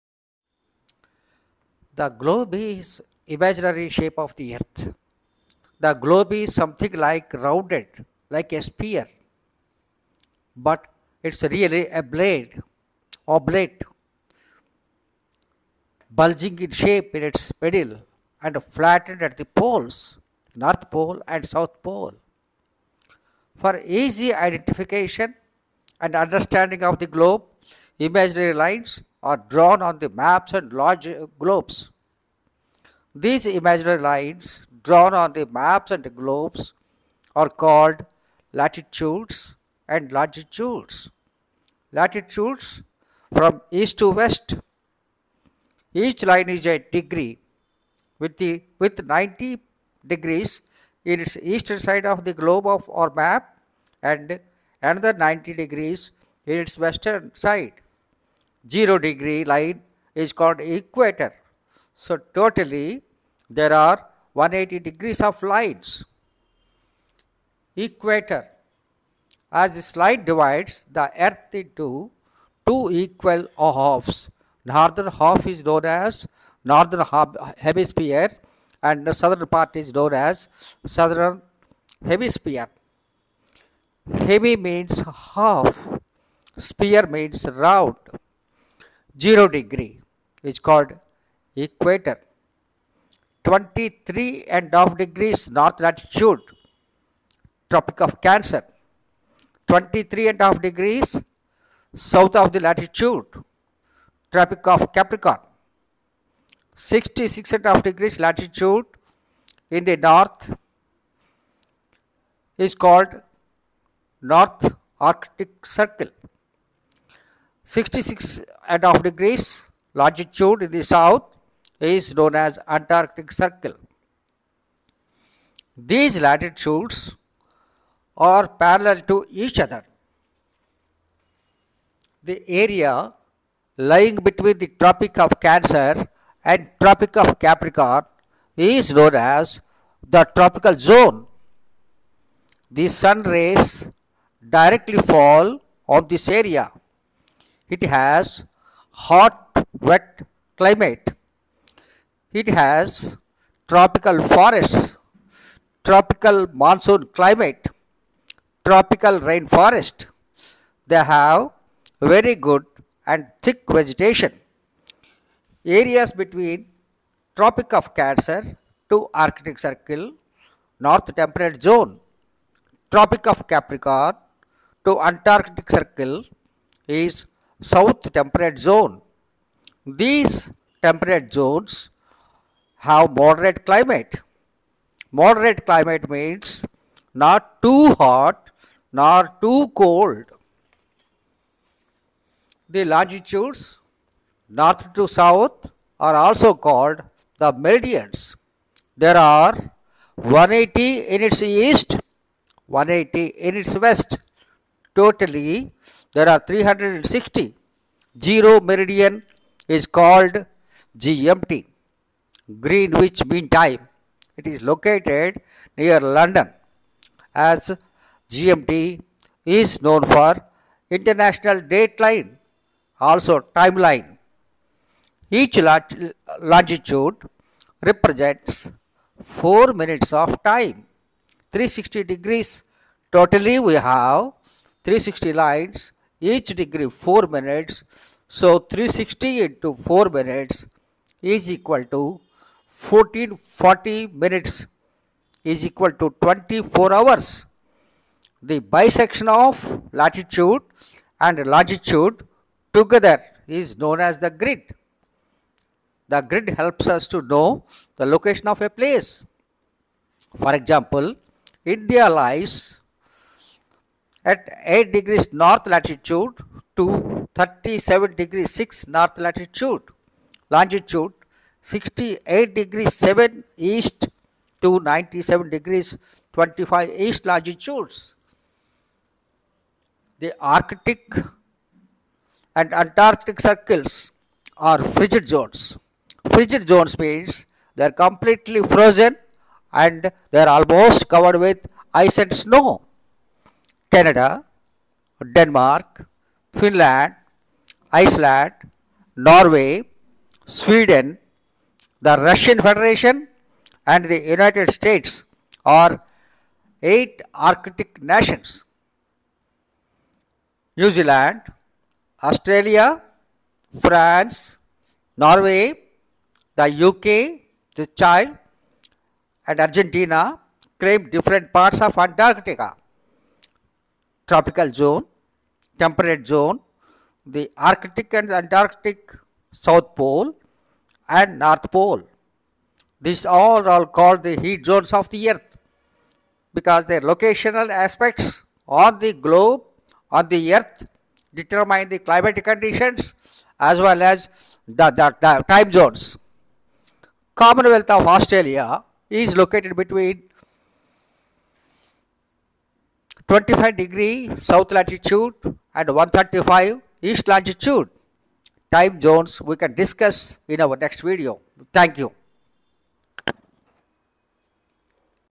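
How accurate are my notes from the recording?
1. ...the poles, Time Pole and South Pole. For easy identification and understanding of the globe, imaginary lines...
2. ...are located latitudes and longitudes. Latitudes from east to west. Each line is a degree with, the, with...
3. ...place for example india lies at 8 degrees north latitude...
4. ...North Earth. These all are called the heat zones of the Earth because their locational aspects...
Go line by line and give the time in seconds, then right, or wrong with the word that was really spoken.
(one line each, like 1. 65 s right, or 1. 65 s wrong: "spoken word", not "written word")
1. 19 s wrong: "North", not "Time"
2. 37 s wrong: "called", not "located"
3. 258 s right
4. 331 s wrong: "Pole", not "Earth".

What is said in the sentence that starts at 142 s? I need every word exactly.
The sun rays directly fall on this area it has hot, wet climate.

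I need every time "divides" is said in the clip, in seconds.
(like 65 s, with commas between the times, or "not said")
70 s.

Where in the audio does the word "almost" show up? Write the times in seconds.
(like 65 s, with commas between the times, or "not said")
290 s.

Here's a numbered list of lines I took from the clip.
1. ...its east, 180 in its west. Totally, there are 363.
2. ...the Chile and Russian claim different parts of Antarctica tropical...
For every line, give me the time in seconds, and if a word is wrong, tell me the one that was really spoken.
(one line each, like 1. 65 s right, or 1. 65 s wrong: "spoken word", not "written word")
1. 201 s wrong: "360", not "363"
2. 317 s wrong: "Argentina", not "Russian".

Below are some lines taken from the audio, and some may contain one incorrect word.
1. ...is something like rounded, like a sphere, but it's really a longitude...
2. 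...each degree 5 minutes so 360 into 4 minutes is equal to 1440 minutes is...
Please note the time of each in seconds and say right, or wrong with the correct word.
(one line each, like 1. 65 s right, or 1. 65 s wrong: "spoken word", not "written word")
1. 6 s wrong: "blade", not "longitude"
2. 236 s wrong: "4", not "5".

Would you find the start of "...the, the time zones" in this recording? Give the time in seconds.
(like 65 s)
344 s.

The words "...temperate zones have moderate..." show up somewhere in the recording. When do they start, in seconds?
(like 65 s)
180 s.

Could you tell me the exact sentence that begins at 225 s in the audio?
Each longitude represents 4 minutes of time, 360 degrees.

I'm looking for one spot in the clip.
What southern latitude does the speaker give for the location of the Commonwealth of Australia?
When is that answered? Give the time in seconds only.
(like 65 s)
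353 s.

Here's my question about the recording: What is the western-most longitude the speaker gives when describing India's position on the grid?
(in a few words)
68 degrees 7 east.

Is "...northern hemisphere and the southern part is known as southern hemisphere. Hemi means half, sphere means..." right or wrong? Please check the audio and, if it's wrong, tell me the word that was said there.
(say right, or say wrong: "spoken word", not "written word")
right.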